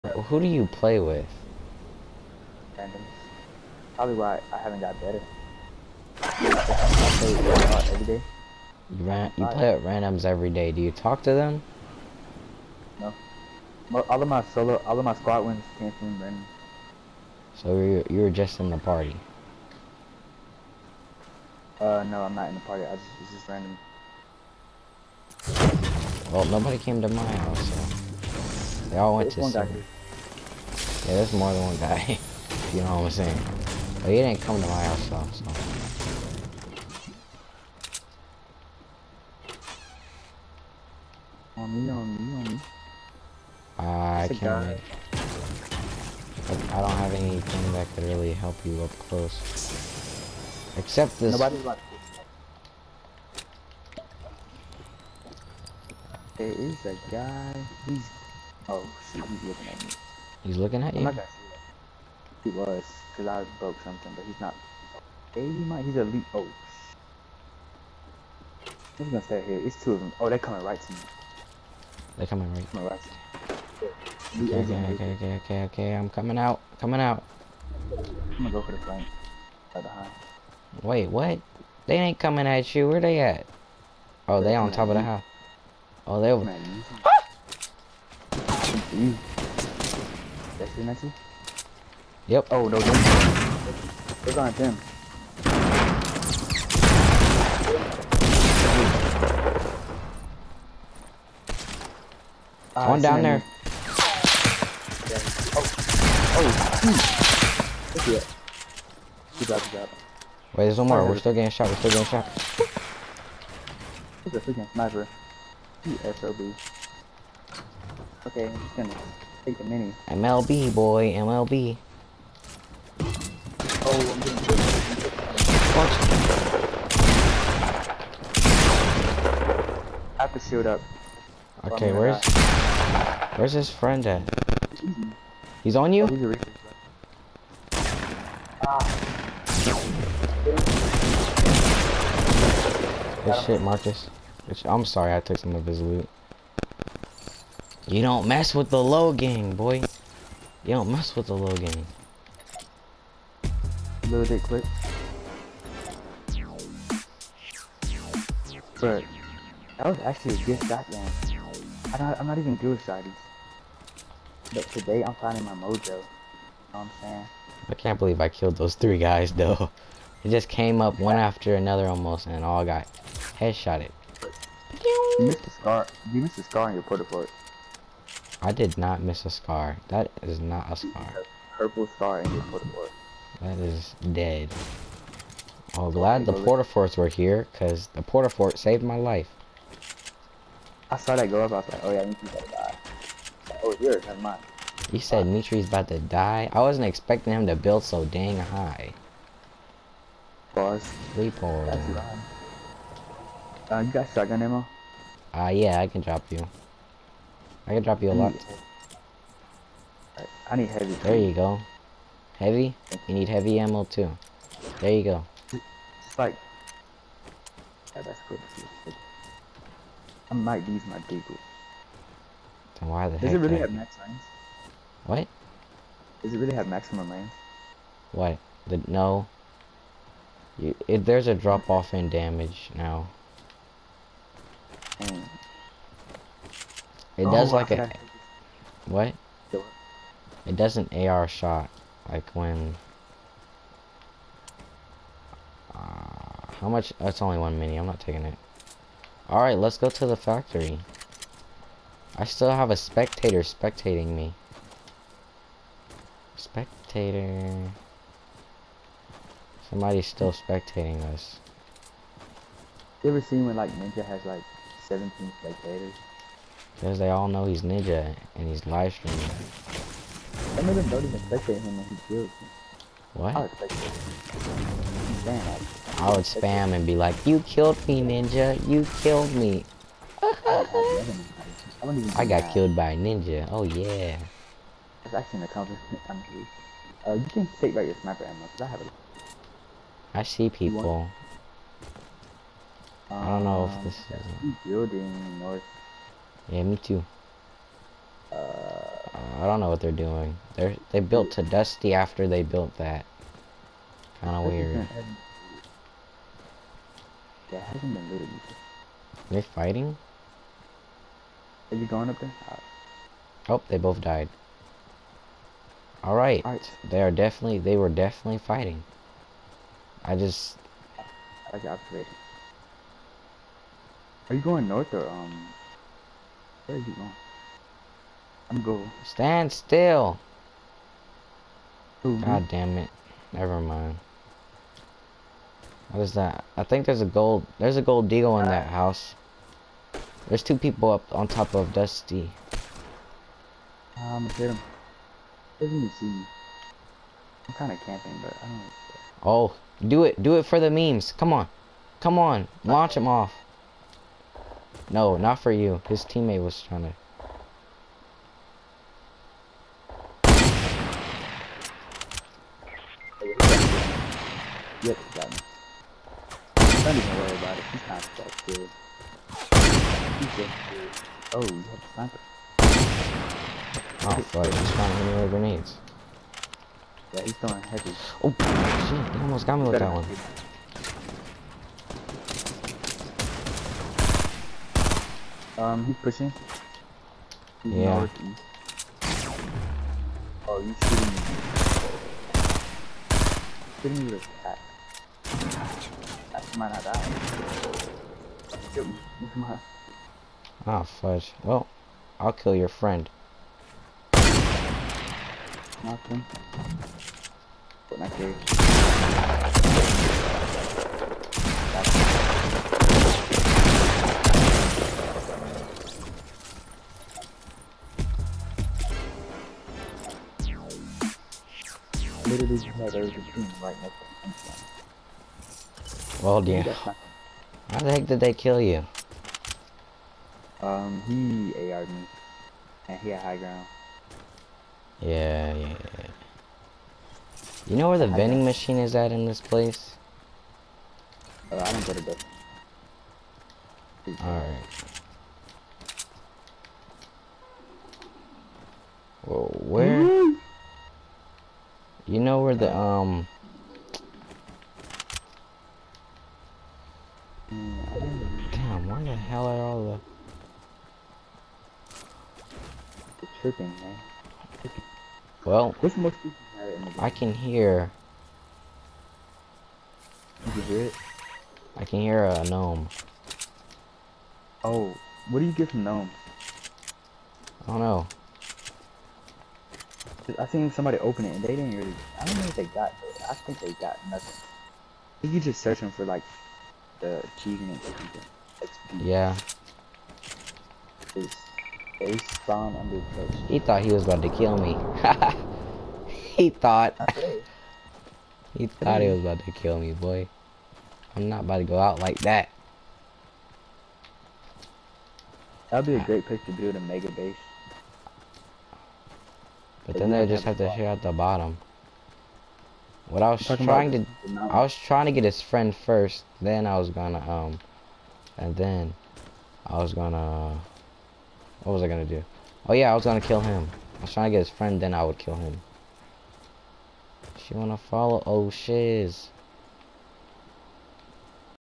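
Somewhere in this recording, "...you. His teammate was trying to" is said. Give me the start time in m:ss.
5:55.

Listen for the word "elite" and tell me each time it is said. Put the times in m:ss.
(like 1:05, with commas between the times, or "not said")
1:05.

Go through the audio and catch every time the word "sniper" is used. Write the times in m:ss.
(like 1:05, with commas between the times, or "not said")
1:54, 4:48, 6:11.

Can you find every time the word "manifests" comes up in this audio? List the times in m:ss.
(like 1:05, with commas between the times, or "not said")
not said.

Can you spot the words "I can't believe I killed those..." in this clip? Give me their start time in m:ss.
2:47.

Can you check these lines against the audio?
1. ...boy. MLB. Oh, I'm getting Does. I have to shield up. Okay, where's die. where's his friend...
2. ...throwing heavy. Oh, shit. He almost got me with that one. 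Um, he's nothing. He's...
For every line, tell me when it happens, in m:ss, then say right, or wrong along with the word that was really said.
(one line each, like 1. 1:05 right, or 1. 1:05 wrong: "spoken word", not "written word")
1. 2:00 wrong: "Watch", not "Does"
2. 6:17 wrong: "pushing", not "nothing".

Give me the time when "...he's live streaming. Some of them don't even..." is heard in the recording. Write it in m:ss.
4:28.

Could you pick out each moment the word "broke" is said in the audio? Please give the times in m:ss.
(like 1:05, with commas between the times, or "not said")
1:03.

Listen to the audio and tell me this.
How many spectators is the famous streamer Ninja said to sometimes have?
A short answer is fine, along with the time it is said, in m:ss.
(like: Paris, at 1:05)
17, at 4:24.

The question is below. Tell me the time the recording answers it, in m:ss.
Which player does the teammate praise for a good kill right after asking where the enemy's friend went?
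2:23.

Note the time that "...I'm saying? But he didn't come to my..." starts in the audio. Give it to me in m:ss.
0:33.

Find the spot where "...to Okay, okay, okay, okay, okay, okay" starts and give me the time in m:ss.
1:13.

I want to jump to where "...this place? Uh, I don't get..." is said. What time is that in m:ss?
7:19.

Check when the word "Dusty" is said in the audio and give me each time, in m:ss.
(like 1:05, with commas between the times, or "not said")
5:01, 5:41.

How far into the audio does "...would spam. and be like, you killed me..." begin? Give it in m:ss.
4:36.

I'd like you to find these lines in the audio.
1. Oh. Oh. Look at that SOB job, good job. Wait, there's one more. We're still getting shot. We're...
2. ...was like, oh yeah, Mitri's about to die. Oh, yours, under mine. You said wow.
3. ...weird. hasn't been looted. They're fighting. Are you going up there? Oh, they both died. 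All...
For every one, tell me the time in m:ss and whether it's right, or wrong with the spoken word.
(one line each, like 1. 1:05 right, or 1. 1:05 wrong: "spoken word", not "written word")
1. 1:45 wrong: "Good", not "SOB"
2. 3:11 wrong: "never", not "under"
3. 5:04 right.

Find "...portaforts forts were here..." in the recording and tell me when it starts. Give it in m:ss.
3:06.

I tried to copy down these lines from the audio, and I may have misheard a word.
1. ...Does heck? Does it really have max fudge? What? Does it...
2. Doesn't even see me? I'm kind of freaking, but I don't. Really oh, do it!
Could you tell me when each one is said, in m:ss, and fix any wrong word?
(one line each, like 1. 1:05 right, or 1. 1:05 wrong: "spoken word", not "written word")
1. 3:43 wrong: "range", not "fudge"
2. 5:45 wrong: "camping", not "freaking".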